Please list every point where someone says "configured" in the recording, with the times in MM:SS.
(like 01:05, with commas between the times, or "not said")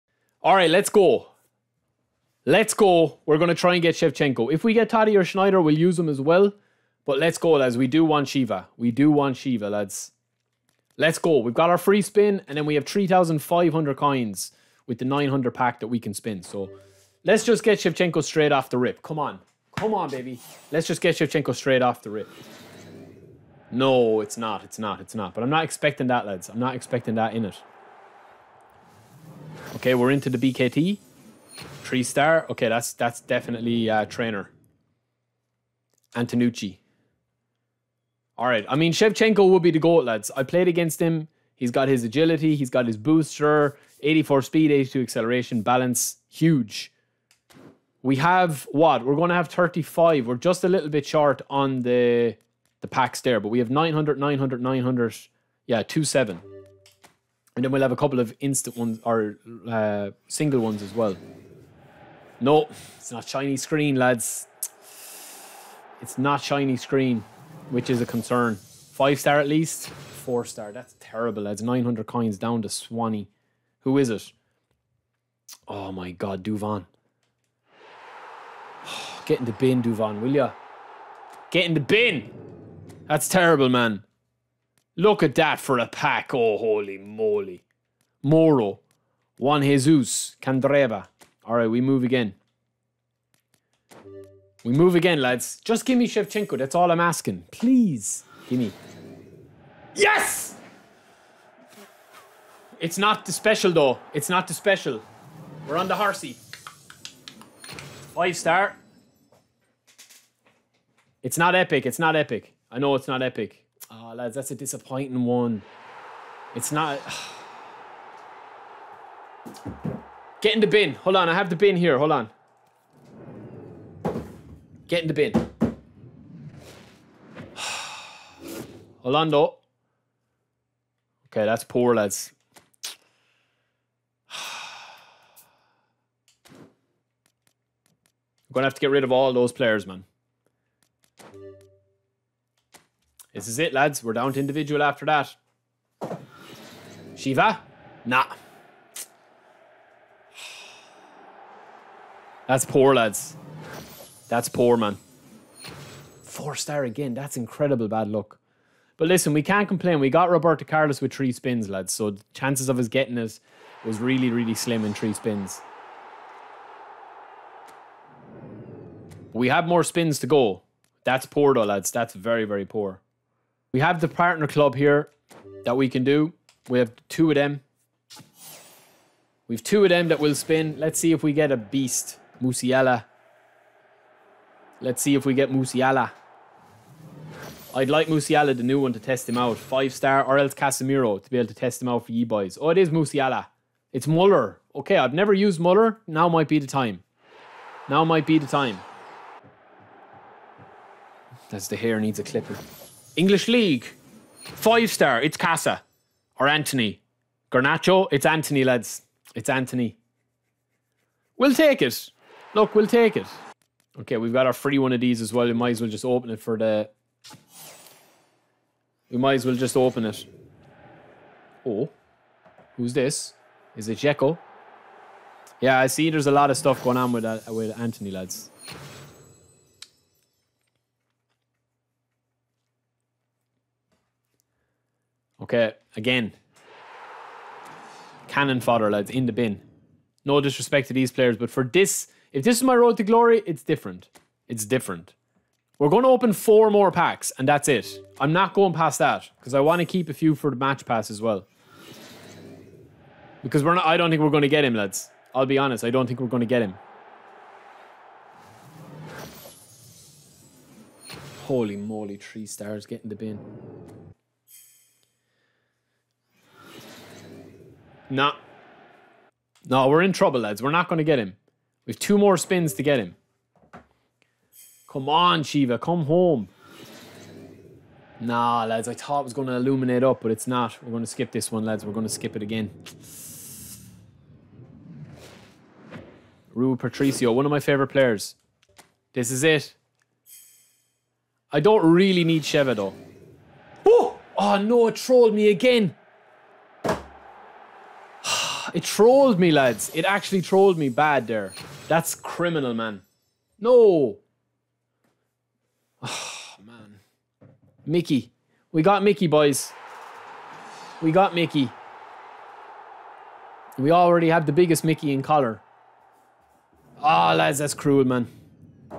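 not said.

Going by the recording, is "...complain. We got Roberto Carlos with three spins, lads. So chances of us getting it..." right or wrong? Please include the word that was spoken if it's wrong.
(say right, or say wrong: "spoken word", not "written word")
right.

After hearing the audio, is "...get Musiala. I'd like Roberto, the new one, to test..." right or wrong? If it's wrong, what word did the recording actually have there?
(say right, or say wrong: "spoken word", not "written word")
wrong: "Musiala", not "Roberto".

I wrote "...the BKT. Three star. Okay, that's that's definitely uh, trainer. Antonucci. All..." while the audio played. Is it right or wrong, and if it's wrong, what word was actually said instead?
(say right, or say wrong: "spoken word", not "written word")
right.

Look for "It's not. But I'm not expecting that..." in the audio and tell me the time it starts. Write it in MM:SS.
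00:25.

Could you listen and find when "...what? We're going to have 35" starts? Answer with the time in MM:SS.
00:48.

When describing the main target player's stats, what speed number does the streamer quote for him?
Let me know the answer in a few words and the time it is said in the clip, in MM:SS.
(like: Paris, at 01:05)
84, at 00:44.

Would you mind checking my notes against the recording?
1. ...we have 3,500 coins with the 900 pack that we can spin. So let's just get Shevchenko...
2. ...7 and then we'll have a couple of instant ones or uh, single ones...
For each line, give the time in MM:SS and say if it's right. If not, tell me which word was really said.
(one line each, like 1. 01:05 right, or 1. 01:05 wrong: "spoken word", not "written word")
1. 00:12 right
2. 00:56 right.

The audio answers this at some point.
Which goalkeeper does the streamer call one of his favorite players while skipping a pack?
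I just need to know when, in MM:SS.
04:46.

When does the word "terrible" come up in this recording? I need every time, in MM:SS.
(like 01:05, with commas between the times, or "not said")
01:10, 01:23.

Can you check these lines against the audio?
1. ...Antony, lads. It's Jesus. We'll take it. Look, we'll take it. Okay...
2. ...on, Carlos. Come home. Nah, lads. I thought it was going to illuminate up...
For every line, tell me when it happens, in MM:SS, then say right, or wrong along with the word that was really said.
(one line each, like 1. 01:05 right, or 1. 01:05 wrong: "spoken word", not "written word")
1. 03:28 wrong: "Antony", not "Jesus"
2. 04:35 wrong: "Sheva", not "Carlos".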